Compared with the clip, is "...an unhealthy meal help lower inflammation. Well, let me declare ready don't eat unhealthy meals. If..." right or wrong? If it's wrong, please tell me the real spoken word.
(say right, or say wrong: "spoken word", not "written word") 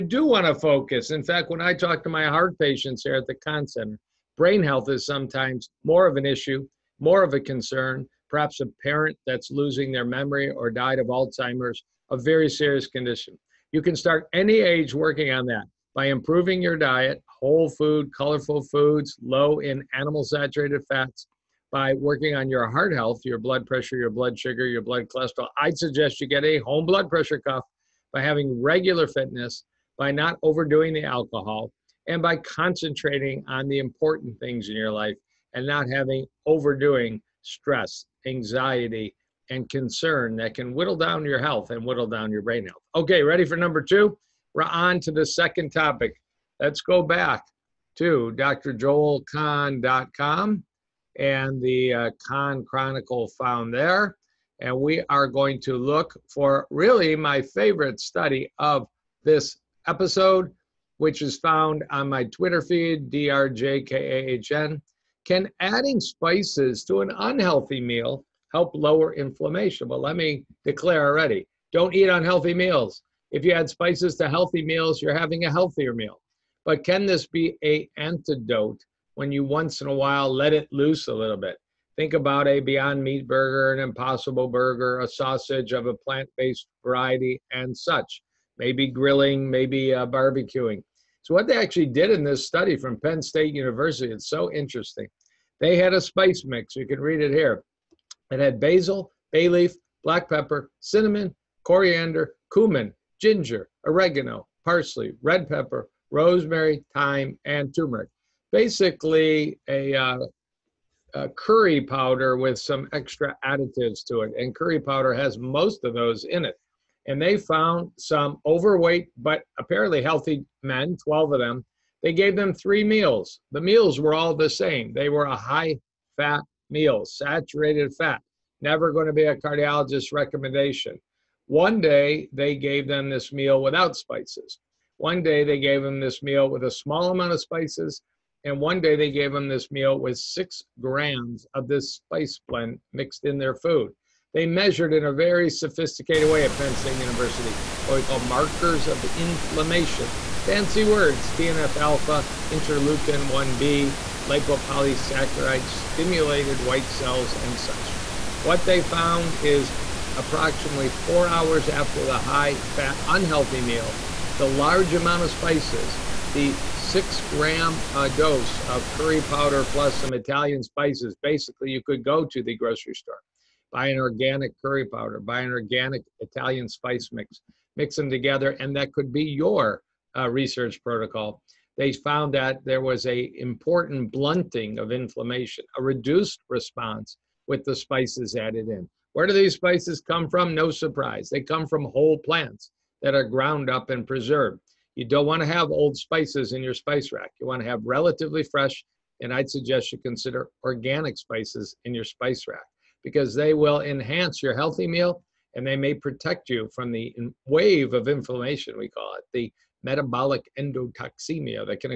wrong: "already", not "ready".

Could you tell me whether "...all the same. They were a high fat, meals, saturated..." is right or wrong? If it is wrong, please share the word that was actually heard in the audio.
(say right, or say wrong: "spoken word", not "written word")
right.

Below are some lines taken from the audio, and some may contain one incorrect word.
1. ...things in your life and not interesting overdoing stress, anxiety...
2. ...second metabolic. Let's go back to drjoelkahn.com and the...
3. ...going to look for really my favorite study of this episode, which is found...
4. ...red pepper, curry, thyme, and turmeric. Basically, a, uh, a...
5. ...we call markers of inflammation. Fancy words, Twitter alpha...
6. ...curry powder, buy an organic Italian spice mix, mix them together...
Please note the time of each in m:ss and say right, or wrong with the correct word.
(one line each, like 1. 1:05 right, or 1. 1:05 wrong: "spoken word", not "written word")
1. 0:34 wrong: "having", not "interesting"
2. 0:45 wrong: "topic", not "metabolic"
3. 0:55 right
4. 1:45 wrong: "rosemary", not "curry"
5. 2:27 wrong: "TNF", not "Twitter"
6. 2:54 right.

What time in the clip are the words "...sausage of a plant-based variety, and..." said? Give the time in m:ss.
1:25.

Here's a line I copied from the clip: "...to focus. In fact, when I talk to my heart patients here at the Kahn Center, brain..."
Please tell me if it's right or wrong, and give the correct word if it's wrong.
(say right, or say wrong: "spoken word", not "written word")
right.